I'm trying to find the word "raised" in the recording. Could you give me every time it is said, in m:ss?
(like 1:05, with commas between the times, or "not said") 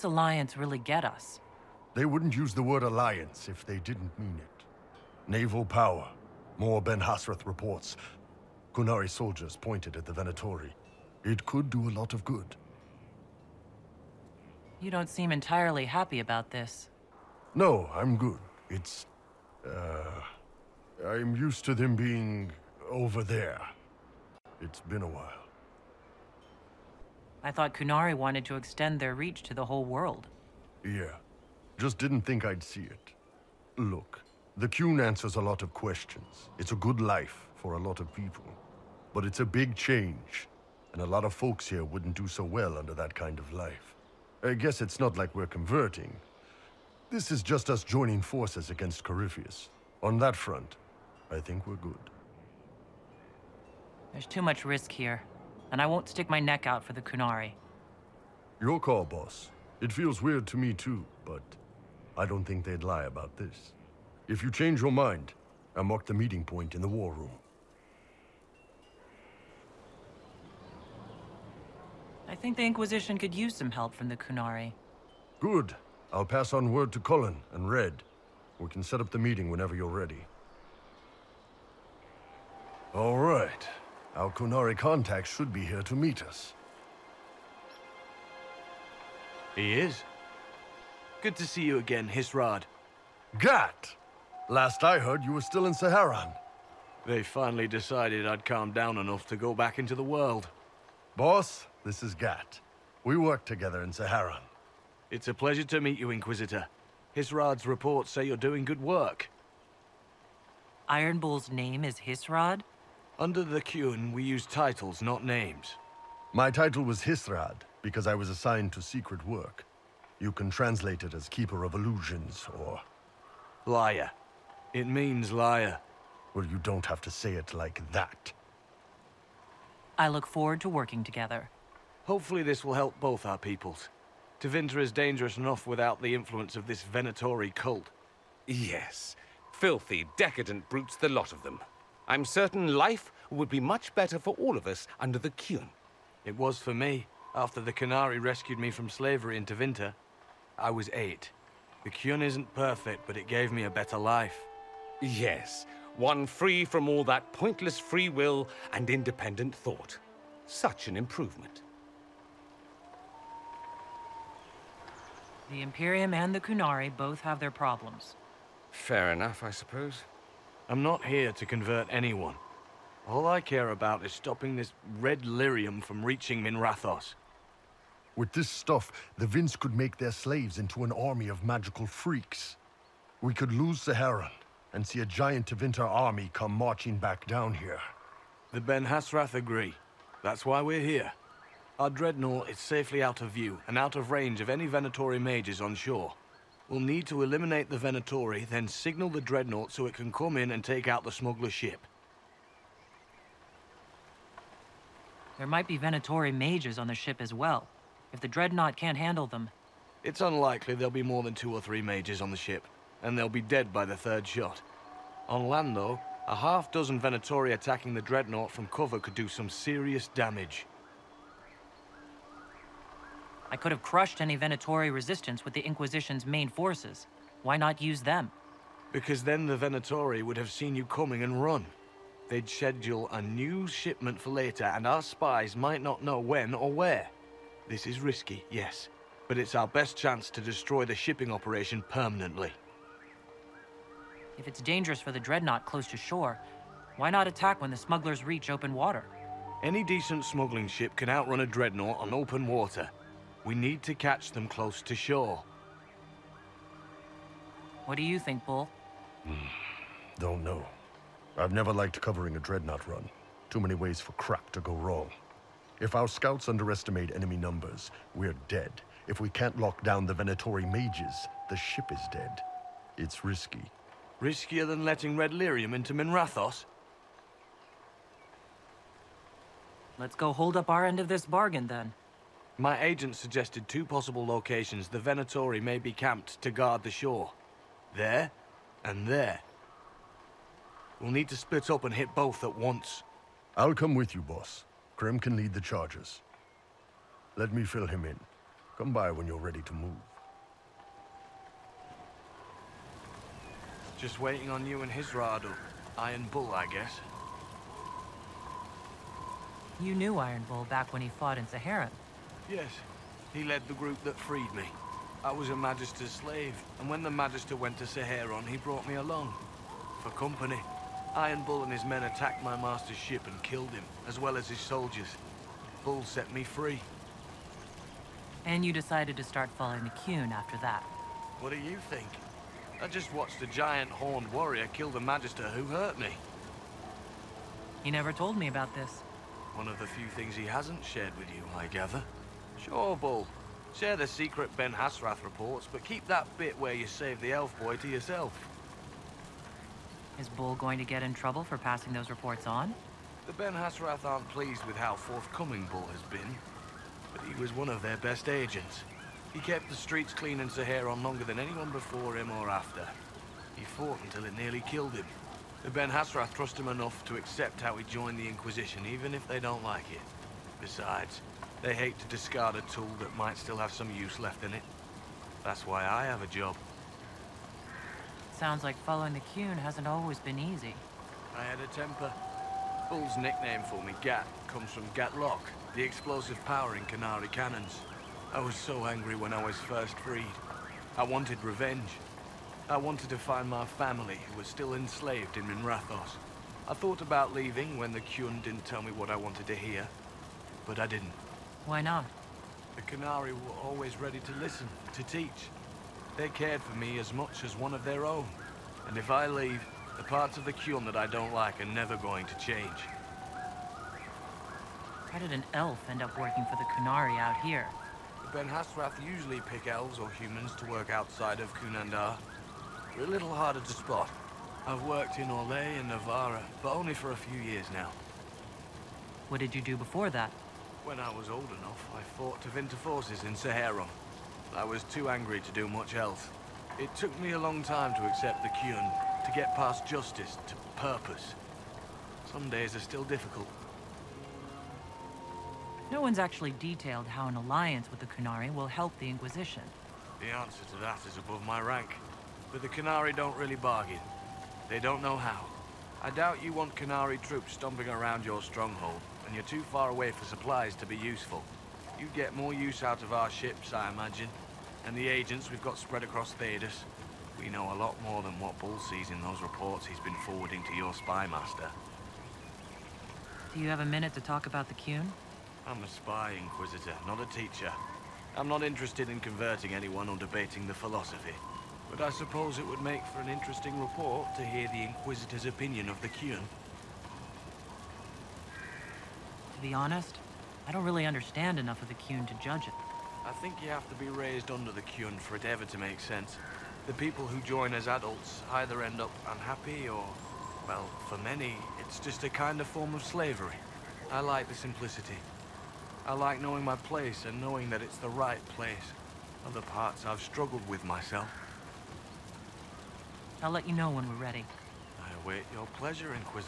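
8:14.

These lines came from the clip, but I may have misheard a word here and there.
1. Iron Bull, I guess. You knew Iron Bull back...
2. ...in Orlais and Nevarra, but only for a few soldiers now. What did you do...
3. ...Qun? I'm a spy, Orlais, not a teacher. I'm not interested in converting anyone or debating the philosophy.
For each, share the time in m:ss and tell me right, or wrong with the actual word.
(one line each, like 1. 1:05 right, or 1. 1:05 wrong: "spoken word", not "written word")
1. 5:05 right
2. 7:05 wrong: "years", not "soldiers"
3. 7:54 wrong: "Inquisitor", not "Orlais".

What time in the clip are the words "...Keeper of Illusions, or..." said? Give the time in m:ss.
2:01.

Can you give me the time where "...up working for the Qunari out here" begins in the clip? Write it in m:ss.
6:56.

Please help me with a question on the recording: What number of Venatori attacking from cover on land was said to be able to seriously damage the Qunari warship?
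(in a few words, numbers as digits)
6.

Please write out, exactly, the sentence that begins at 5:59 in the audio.
He kept the streets clean in Seheron longer than anyone before him or after.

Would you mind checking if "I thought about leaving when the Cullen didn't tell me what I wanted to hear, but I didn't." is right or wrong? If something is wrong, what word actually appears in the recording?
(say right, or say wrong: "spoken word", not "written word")
wrong: "Qun", not "Cullen".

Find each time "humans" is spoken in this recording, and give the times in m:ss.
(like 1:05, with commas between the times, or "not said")
7:00.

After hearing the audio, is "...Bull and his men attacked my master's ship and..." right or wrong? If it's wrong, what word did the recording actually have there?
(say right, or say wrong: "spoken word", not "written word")
right.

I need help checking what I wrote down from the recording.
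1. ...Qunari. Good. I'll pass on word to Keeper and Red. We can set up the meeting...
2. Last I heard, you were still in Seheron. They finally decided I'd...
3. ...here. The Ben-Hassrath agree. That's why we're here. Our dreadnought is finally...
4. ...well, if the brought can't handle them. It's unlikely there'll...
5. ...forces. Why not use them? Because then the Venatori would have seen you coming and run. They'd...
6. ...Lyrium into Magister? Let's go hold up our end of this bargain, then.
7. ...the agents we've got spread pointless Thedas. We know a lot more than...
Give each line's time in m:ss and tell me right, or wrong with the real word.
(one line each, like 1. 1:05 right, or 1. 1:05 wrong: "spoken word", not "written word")
1. 1:14 wrong: "Cullen", not "Keeper"
2. 1:34 right
3. 3:07 wrong: "safely", not "finally"
4. 3:27 wrong: "dreadnought", not "brought"
5. 3:46 right
6. 4:35 wrong: "Minrathous", not "Magister"
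7. 7:44 wrong: "across", not "pointless".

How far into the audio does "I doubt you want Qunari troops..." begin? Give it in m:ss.
7:36.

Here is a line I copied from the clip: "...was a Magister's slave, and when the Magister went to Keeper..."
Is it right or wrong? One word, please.
wrong.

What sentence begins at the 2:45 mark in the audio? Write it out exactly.
The Imperium and the Qunari both have their problems.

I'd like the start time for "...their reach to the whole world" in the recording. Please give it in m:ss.
0:28.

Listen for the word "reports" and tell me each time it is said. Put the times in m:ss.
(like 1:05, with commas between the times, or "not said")
0:07, 1:47, 5:45, 5:52, 7:49, 8:03.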